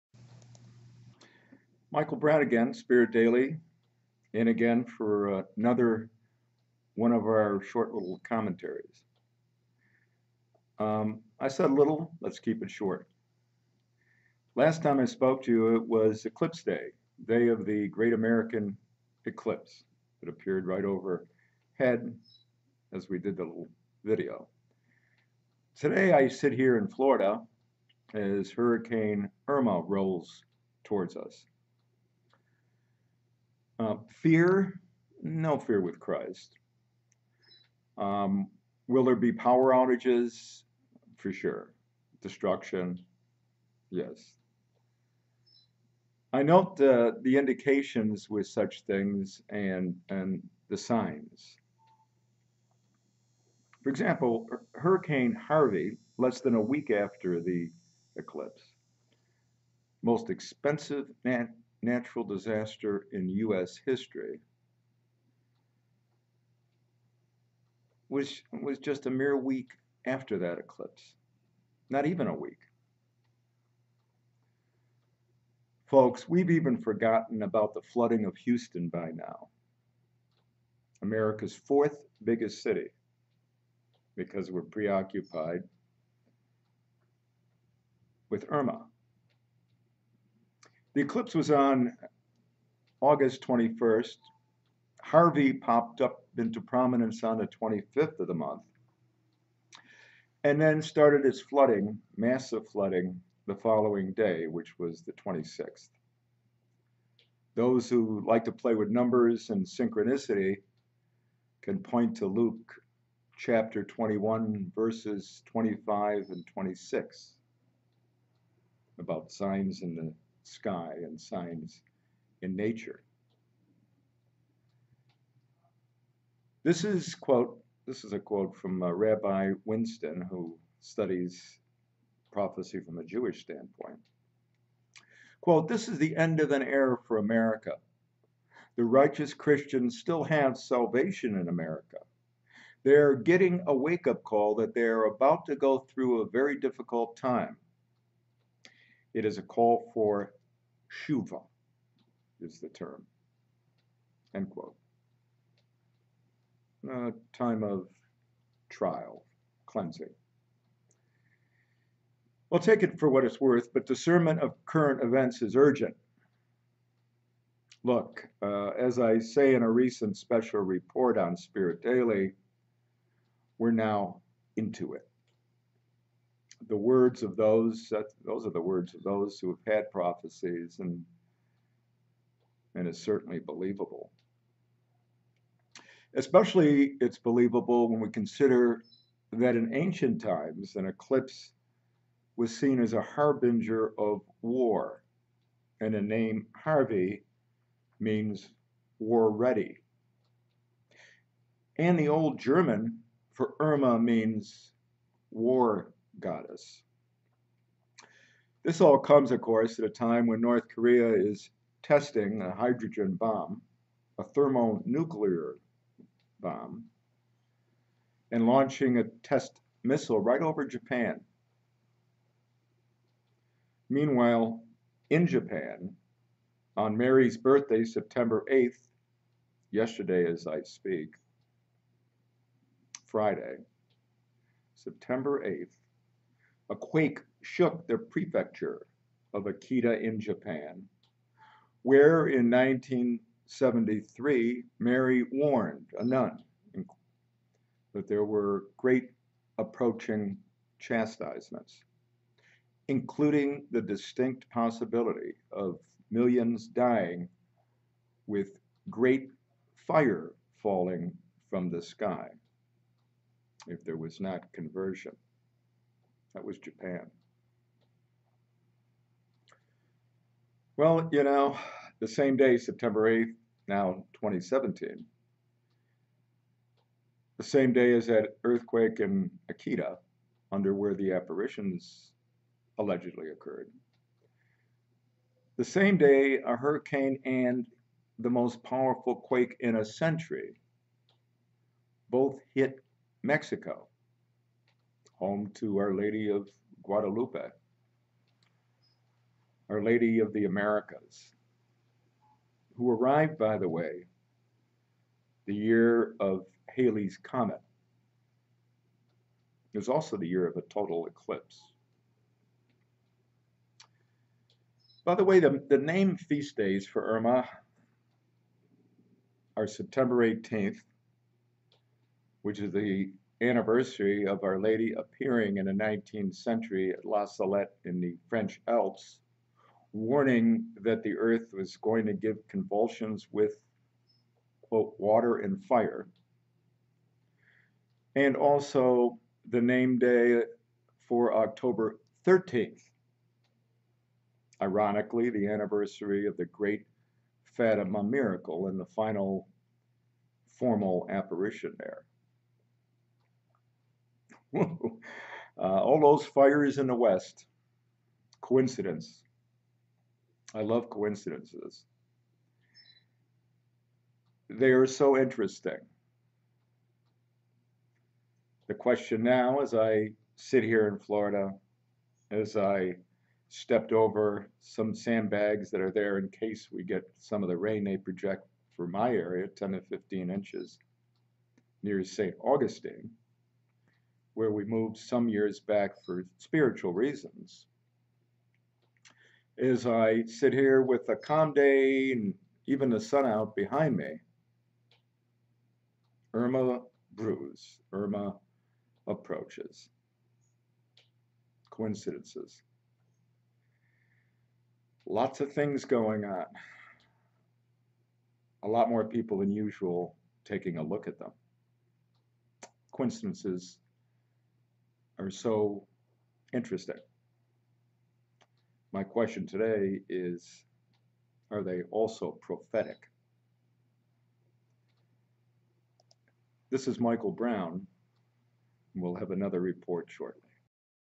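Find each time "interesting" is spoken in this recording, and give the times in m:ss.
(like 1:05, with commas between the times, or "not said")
6:05, 6:56.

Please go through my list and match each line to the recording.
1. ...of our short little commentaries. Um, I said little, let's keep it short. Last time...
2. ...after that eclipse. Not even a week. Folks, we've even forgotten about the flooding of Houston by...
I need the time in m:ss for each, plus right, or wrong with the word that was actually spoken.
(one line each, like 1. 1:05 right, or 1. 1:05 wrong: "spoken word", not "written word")
1. 0:07 right
2. 1:10 right.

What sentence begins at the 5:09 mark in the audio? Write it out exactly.
It was also the year of a total eclipse.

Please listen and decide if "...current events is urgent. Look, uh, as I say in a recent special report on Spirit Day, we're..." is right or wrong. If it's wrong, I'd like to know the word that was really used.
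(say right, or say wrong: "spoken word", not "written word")
wrong: "Daily", not "Day".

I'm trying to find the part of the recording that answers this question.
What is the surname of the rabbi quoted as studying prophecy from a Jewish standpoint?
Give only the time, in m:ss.
2:09.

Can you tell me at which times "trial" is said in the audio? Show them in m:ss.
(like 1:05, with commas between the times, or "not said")
2:38.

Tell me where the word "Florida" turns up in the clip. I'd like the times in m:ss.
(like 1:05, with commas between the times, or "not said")
0:26, 6:10.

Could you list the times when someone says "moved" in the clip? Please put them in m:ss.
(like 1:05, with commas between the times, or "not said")
6:24.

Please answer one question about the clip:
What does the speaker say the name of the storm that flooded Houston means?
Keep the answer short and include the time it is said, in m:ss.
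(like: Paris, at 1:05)
war ready, at 3:18.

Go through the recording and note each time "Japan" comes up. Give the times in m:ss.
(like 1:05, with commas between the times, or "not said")
3:40, 3:45, 4:00, 4:26.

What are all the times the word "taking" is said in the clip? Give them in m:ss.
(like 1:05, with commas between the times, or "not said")
6:50.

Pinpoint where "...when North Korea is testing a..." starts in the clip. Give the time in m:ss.
3:30.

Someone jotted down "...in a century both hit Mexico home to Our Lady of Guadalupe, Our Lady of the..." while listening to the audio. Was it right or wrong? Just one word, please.
right.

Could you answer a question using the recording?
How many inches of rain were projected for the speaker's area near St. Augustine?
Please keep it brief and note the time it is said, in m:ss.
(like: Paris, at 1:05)
10 to 15 inches, at 6:19.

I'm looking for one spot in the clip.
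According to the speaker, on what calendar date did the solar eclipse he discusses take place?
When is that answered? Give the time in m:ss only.
1:32.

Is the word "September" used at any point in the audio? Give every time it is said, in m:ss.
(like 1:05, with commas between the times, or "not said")
3:47, 3:54, 4:32, 5:19.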